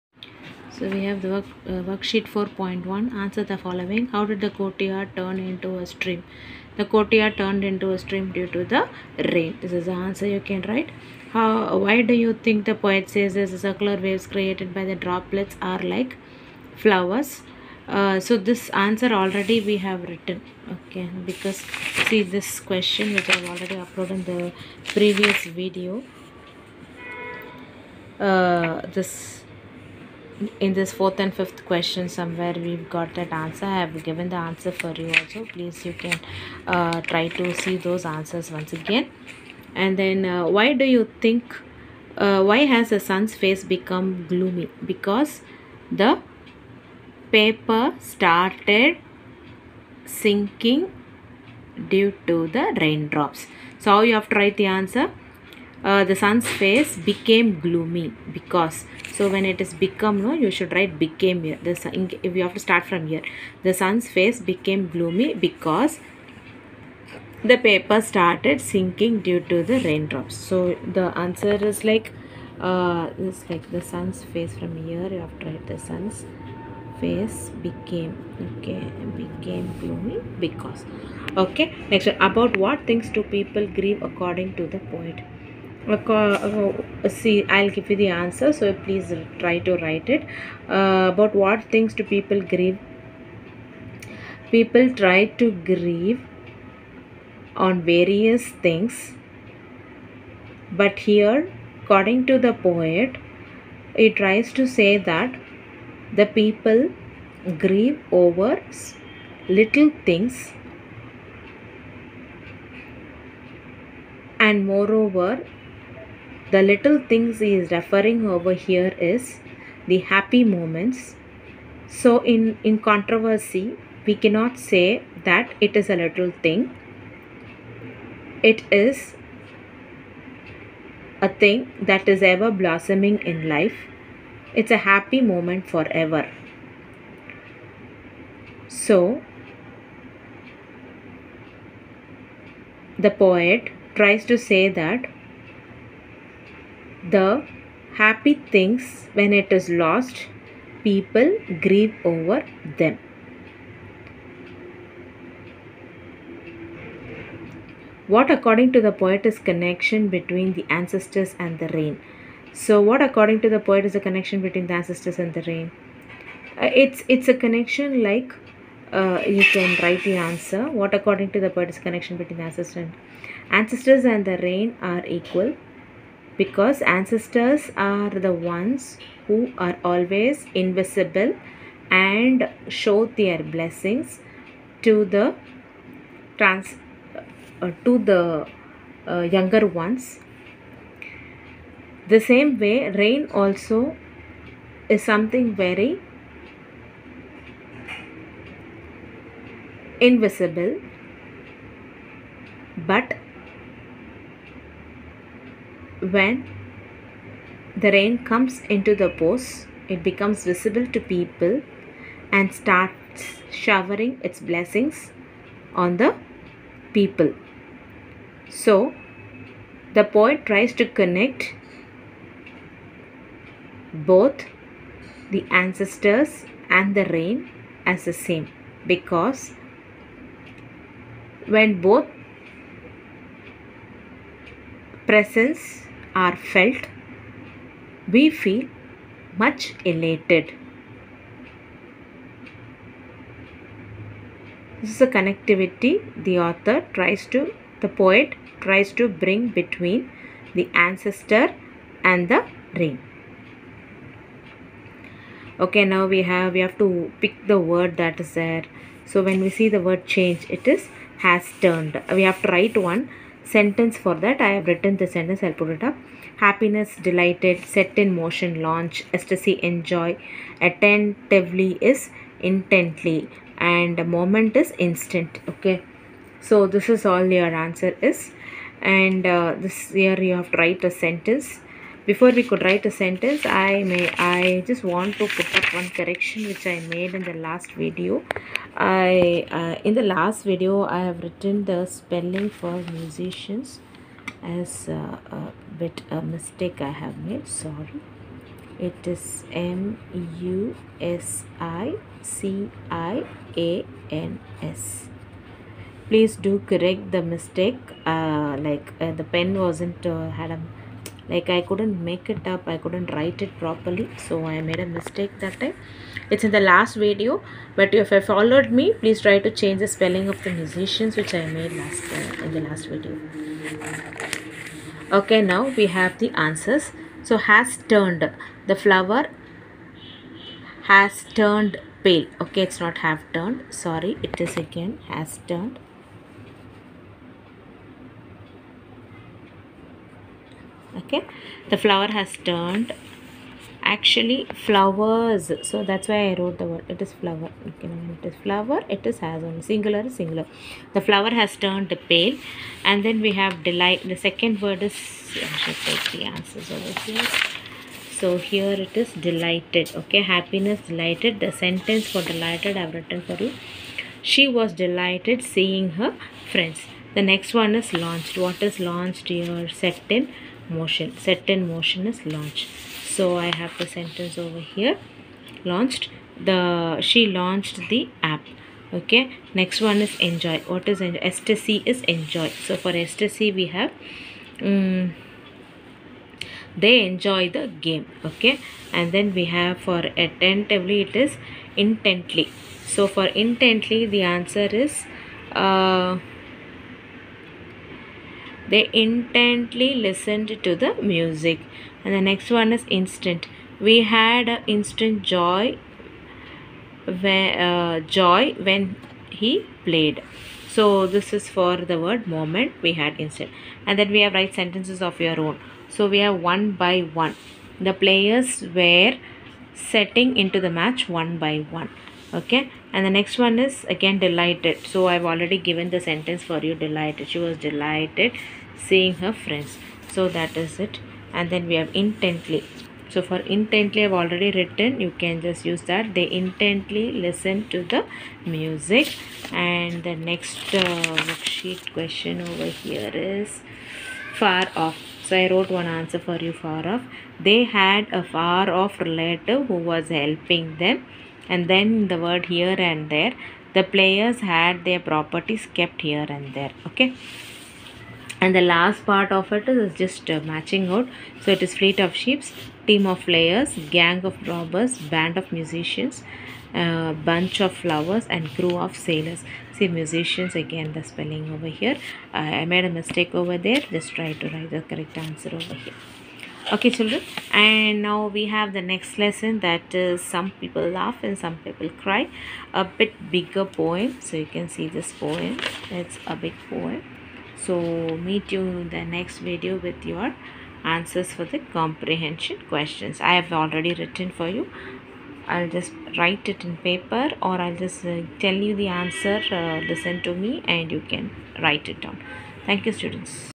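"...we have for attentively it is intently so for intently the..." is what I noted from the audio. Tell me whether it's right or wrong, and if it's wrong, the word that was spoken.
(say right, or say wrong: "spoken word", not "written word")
right.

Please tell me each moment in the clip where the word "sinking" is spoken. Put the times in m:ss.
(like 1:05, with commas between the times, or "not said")
0:50, 1:08.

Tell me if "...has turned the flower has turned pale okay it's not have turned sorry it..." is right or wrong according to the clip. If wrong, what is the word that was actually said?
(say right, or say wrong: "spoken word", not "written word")
right.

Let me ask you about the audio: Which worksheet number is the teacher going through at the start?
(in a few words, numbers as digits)
4.1.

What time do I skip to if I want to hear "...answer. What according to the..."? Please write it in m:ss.
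2:50.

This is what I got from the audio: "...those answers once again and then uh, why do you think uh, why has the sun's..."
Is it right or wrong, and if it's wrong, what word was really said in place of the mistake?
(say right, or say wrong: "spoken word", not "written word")
right.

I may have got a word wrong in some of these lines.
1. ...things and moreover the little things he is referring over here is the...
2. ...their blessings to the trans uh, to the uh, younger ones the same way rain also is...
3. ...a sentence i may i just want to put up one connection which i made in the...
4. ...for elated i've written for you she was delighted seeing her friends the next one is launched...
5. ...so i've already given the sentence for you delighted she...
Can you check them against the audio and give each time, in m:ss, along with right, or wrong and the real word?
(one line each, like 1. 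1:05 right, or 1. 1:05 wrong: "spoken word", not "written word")
1. 1:50 right
2. 3:03 right
3. 4:42 wrong: "correction", not "connection"
4. 6:02 wrong: "delighted", not "elated"
5. 7:04 right.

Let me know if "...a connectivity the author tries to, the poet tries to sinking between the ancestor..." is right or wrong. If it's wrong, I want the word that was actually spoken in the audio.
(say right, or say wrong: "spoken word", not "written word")
wrong: "bring", not "sinking".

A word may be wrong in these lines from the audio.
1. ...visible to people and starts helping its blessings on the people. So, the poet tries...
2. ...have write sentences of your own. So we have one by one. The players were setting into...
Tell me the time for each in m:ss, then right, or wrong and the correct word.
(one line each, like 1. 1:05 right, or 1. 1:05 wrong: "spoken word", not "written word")
1. 3:30 wrong: "showering", not "helping"
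2. 6:54 right.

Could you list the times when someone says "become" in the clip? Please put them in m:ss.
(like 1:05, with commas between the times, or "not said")
0:43, 0:59, 3:30.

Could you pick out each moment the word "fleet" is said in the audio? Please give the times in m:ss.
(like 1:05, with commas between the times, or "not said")
7:41.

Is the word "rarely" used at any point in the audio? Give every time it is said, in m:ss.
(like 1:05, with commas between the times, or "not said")
not said.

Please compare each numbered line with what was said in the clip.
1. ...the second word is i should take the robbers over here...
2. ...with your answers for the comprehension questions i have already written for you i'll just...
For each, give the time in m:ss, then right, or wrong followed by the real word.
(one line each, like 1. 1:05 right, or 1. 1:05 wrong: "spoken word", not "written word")
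1. 5:54 wrong: "answers", not "robbers"
2. 8:09 right.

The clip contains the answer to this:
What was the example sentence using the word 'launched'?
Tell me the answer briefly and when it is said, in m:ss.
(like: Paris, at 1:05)
She launched the app, at 6:17.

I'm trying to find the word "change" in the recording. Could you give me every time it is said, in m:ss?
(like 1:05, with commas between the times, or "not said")
4:20, 5:19.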